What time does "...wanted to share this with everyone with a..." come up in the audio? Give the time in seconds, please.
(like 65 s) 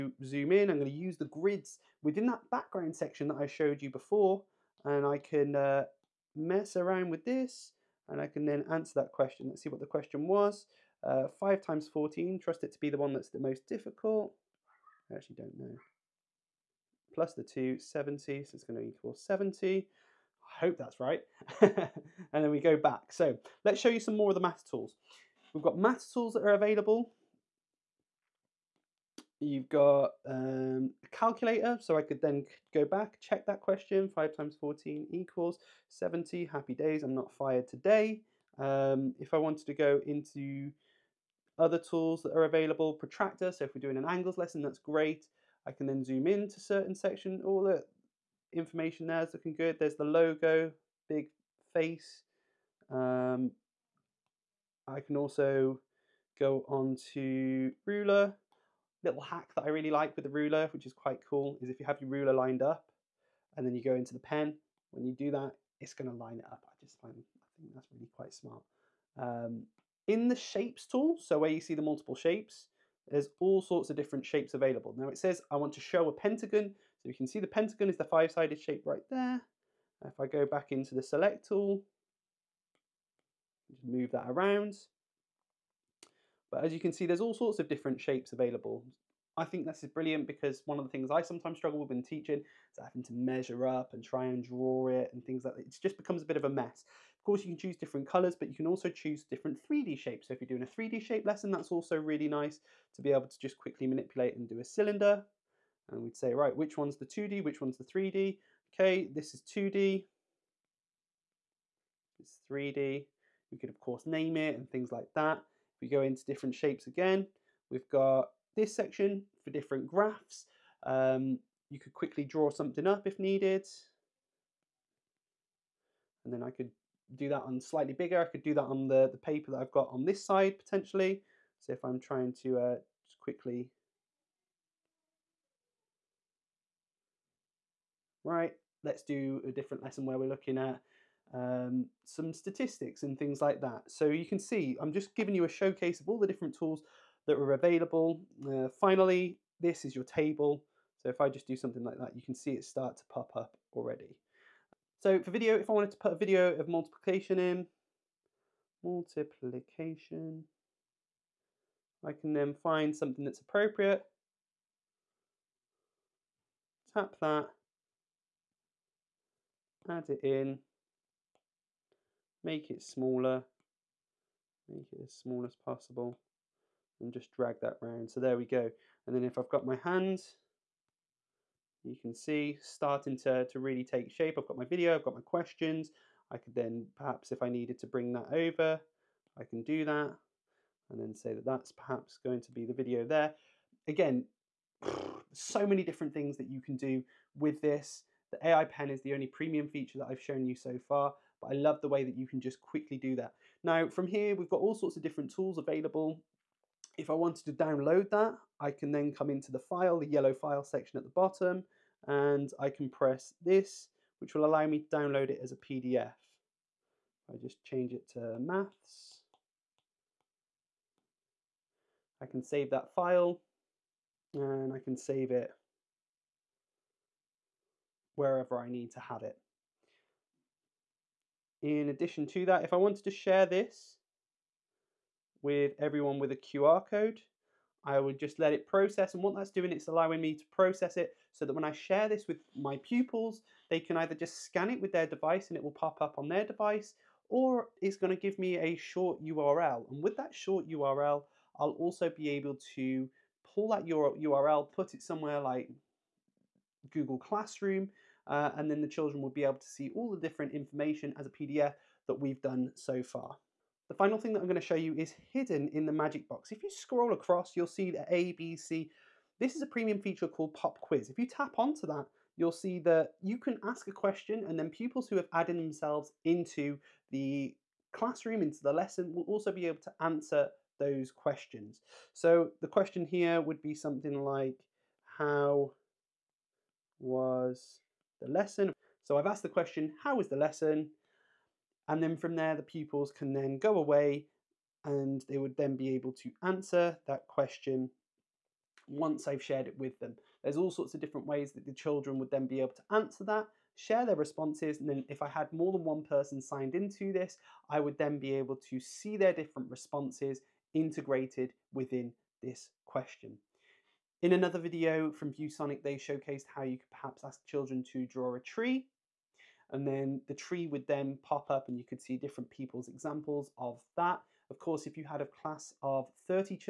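232 s.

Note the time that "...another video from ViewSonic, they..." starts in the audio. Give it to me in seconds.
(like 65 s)
314 s.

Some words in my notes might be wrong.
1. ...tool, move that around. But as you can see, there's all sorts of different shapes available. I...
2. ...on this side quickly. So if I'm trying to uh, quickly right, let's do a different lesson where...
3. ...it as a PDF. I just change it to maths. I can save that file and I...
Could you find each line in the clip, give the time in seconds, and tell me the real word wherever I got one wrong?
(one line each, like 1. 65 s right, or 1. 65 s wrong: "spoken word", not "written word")
1. 81 s right
2. 129 s wrong: "potentially", not "quickly"
3. 215 s right.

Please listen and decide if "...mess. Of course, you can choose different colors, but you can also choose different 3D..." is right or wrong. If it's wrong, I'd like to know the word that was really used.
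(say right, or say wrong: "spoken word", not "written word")
right.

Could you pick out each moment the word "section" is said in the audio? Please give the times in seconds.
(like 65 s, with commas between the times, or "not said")
2 s, 46 s, 118 s, 210 s.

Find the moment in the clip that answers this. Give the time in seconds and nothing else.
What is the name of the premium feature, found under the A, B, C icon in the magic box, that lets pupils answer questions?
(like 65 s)
270 s.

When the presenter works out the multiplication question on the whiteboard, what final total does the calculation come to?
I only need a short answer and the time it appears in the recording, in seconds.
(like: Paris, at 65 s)
70, at 18 s.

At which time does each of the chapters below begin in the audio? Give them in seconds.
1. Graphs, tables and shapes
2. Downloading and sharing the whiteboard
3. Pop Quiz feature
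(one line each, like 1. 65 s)
1. 63 s
2. 210 s
3. 265 s.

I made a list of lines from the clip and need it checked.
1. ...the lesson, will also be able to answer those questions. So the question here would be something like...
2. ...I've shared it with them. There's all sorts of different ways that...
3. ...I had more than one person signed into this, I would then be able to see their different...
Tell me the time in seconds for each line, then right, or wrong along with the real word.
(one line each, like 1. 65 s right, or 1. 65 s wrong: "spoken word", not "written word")
1. 278 s right
2. 299 s right
3. 305 s right.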